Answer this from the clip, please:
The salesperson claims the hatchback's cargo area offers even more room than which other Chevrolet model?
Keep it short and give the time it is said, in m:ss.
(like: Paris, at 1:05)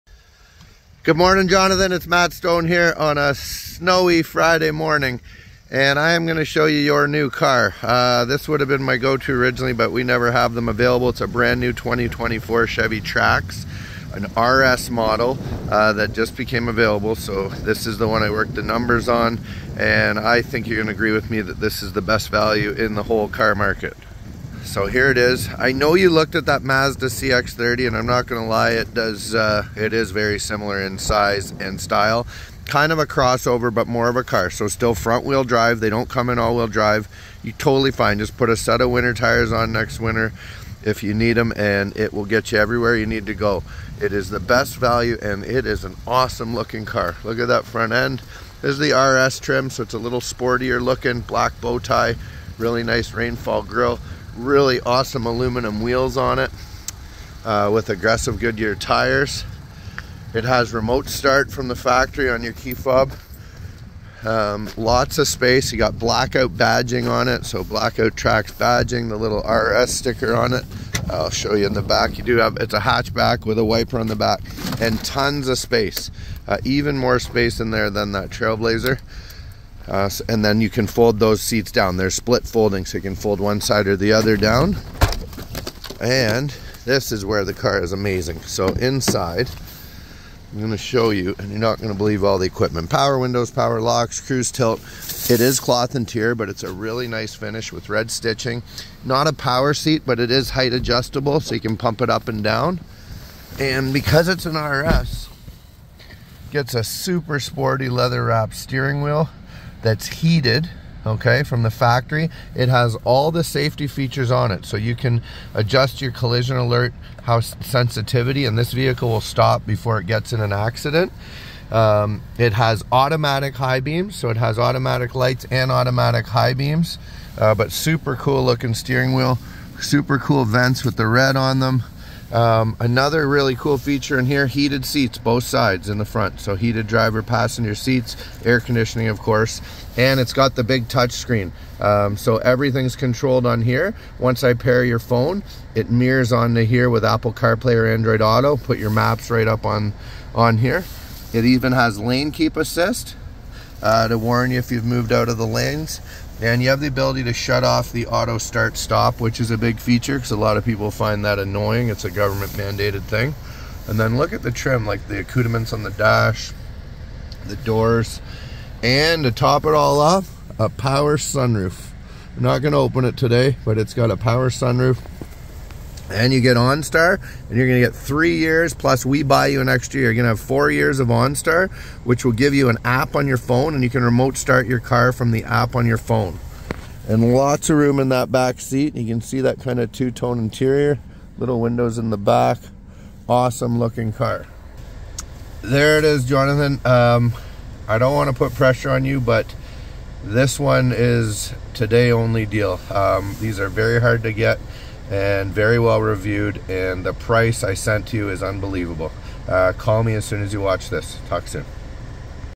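Trailblazer, at 1:18.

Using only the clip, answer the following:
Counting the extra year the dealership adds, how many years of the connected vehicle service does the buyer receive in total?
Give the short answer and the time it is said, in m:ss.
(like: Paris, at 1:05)
4, at 3:00.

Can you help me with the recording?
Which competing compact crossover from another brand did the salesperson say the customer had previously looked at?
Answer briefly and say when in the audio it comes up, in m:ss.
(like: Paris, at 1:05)
Mazda CX-30, at 0:26.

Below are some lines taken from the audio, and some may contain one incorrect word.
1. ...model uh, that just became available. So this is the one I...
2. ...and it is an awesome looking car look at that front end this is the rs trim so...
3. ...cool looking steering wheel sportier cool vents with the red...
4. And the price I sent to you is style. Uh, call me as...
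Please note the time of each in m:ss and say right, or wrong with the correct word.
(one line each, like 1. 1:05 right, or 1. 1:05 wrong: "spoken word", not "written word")
1. 0:14 right
2. 0:45 right
3. 2:08 wrong: "super", not "sportier"
4. 3:26 wrong: "unbelievable", not "style".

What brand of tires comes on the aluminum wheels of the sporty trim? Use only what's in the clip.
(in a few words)
Goodyear.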